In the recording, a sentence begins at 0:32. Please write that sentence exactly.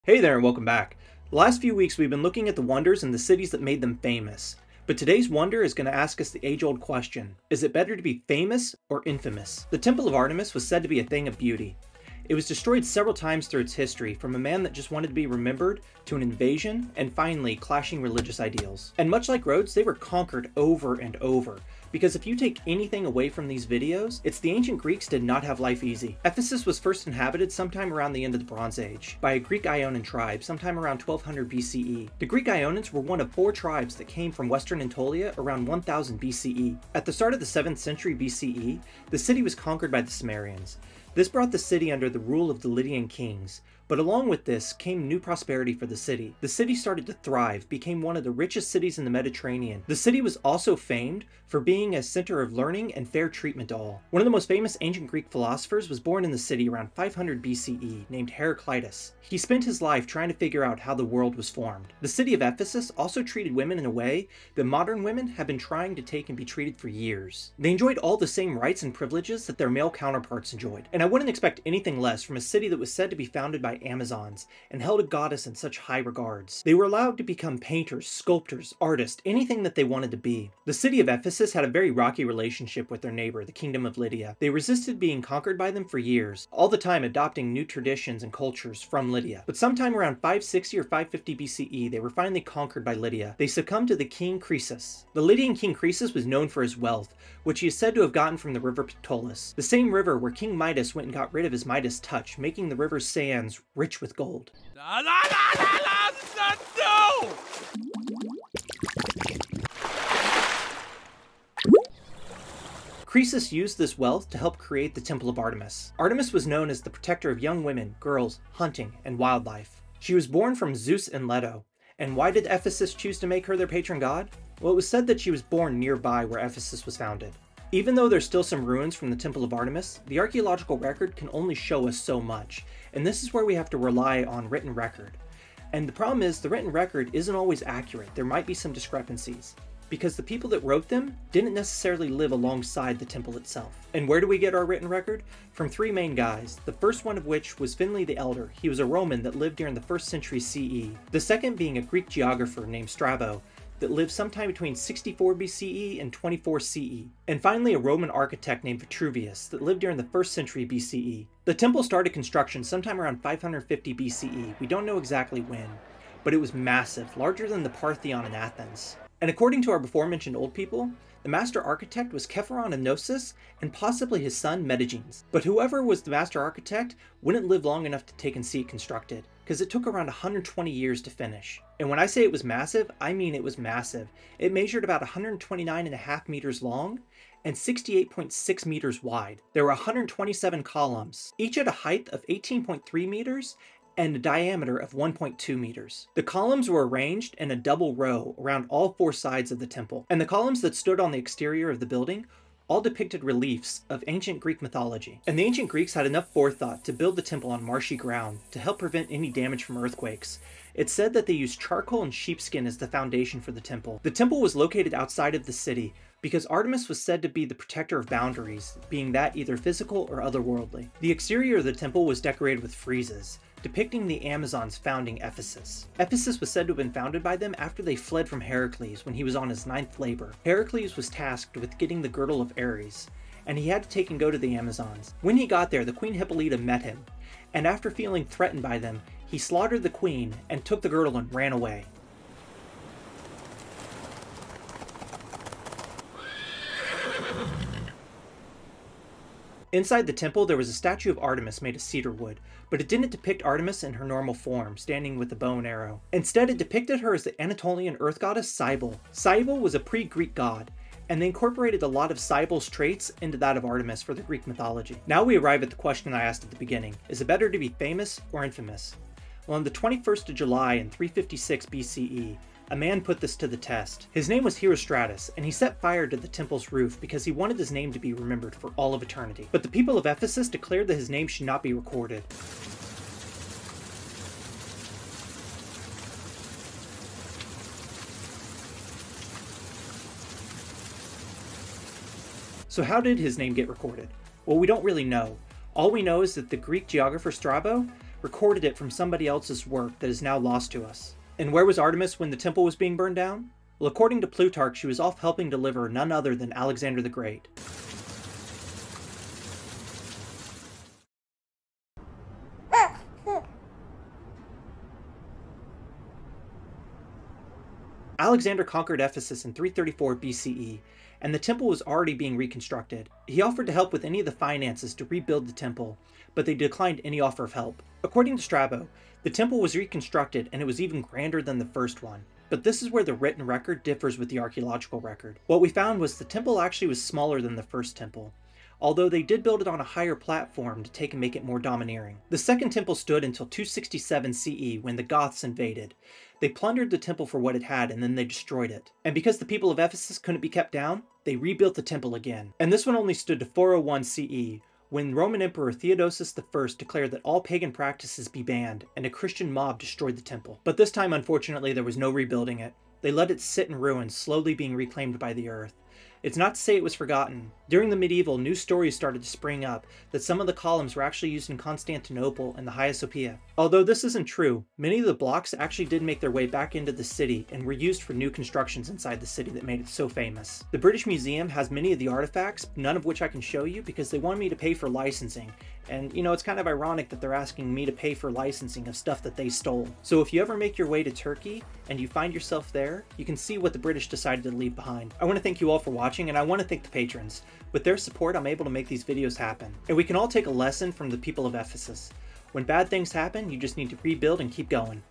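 The Greek Ionians were one of four tribes that came from western Anatolia around 1000 BCE.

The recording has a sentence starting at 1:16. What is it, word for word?
They were allowed to become painters, sculptors, artists, anything that they wanted to be.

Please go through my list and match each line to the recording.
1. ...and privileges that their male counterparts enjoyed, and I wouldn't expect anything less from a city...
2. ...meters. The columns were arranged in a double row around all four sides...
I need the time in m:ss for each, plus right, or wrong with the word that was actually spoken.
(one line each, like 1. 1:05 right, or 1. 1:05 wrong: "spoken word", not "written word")
1. 1:08 right
2. 3:15 right.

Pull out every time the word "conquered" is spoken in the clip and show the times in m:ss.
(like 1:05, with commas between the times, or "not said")
0:19, 0:39, 1:25, 1:32, 5:18.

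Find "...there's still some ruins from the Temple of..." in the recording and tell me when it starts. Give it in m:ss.
2:08.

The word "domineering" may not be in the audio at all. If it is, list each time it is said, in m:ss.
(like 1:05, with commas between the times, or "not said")
5:41.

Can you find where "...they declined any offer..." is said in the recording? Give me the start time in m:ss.
5:26.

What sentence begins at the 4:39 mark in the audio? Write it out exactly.
But the people of Ephesus declared that his name should not be recorded.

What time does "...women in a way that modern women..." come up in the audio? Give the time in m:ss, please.
1:03.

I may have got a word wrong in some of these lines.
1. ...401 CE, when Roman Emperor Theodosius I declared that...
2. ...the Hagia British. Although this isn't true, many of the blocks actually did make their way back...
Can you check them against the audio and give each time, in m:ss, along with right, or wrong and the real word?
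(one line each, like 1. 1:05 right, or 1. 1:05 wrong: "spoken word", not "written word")
1. 5:53 right
2. 6:12 wrong: "Sophia", not "British".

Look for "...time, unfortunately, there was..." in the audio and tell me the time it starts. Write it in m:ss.
6:00.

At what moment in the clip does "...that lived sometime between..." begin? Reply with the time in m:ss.
2:33.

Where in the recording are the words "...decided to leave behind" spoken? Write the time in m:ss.
6:34.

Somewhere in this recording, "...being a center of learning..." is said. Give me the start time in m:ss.
0:51.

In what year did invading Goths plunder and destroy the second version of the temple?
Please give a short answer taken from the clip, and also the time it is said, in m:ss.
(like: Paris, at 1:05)
267 CE, at 5:43.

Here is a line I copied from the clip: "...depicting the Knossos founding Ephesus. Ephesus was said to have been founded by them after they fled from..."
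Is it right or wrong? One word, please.
wrong.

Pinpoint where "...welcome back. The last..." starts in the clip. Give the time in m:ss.
0:00.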